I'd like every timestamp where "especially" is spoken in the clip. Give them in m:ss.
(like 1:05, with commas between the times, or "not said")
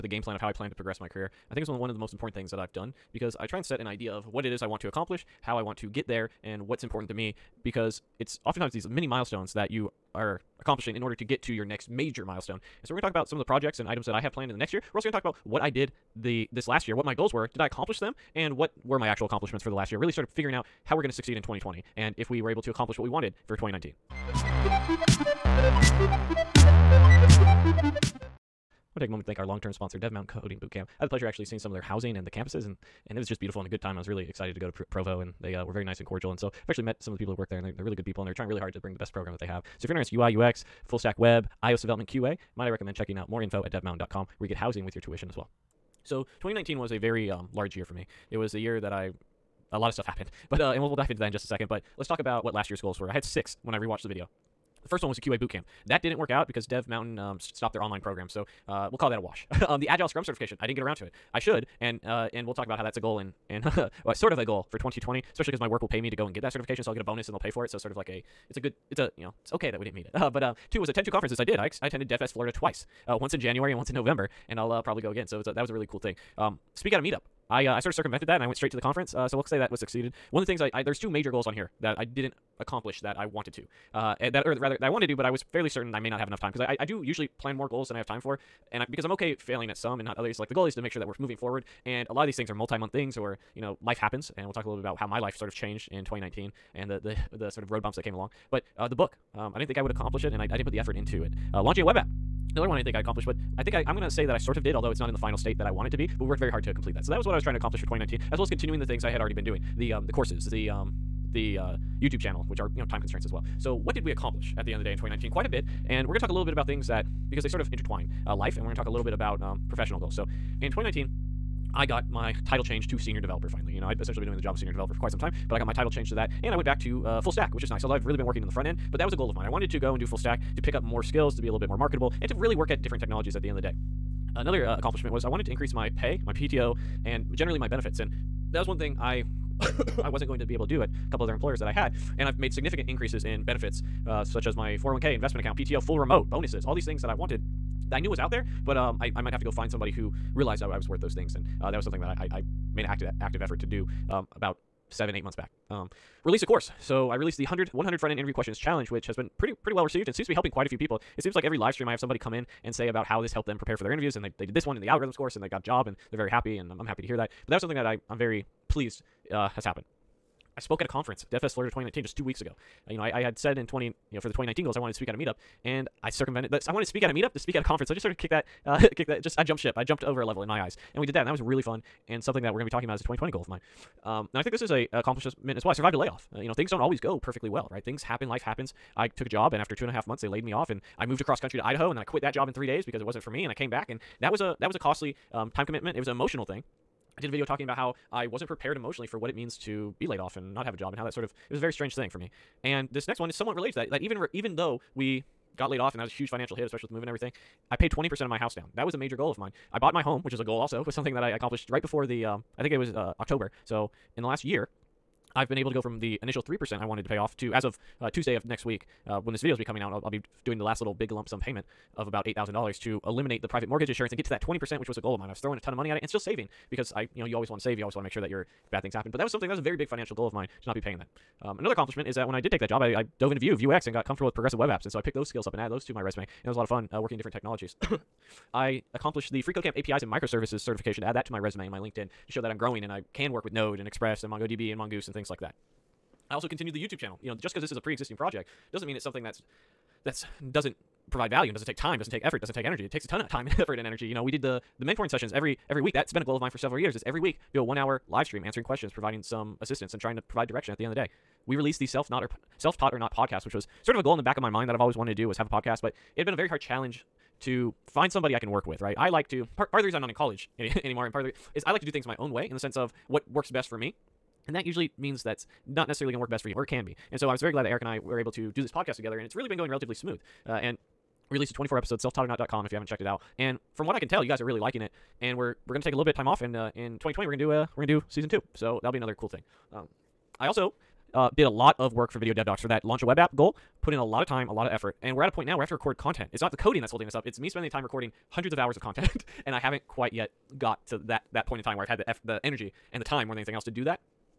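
1:05, 3:26.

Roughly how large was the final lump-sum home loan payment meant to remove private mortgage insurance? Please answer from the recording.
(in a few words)
$8,000.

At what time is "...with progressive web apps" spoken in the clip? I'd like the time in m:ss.
3:54.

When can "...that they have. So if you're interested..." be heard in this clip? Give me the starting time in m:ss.
0:39.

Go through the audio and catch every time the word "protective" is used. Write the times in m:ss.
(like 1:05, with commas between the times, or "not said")
not said.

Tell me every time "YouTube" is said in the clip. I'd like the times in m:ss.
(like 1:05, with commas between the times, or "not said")
1:52, 4:06.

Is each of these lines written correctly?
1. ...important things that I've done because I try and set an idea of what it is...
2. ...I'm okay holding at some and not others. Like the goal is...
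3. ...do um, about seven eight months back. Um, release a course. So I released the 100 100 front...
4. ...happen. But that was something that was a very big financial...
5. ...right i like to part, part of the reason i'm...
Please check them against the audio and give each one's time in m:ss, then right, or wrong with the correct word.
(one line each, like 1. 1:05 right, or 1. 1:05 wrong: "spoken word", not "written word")
1. 0:02 right
2. 1:29 wrong: "failing", not "holding"
3. 2:33 right
4. 3:48 right
5. 4:28 right.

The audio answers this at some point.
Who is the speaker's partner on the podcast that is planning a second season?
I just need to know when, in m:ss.
4:37.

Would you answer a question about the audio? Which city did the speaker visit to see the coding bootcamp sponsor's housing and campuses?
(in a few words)
Provo.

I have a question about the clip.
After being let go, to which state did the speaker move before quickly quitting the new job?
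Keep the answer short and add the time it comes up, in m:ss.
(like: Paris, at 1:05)
Idaho, at 3:11.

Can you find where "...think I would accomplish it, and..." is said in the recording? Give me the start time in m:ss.
1:39.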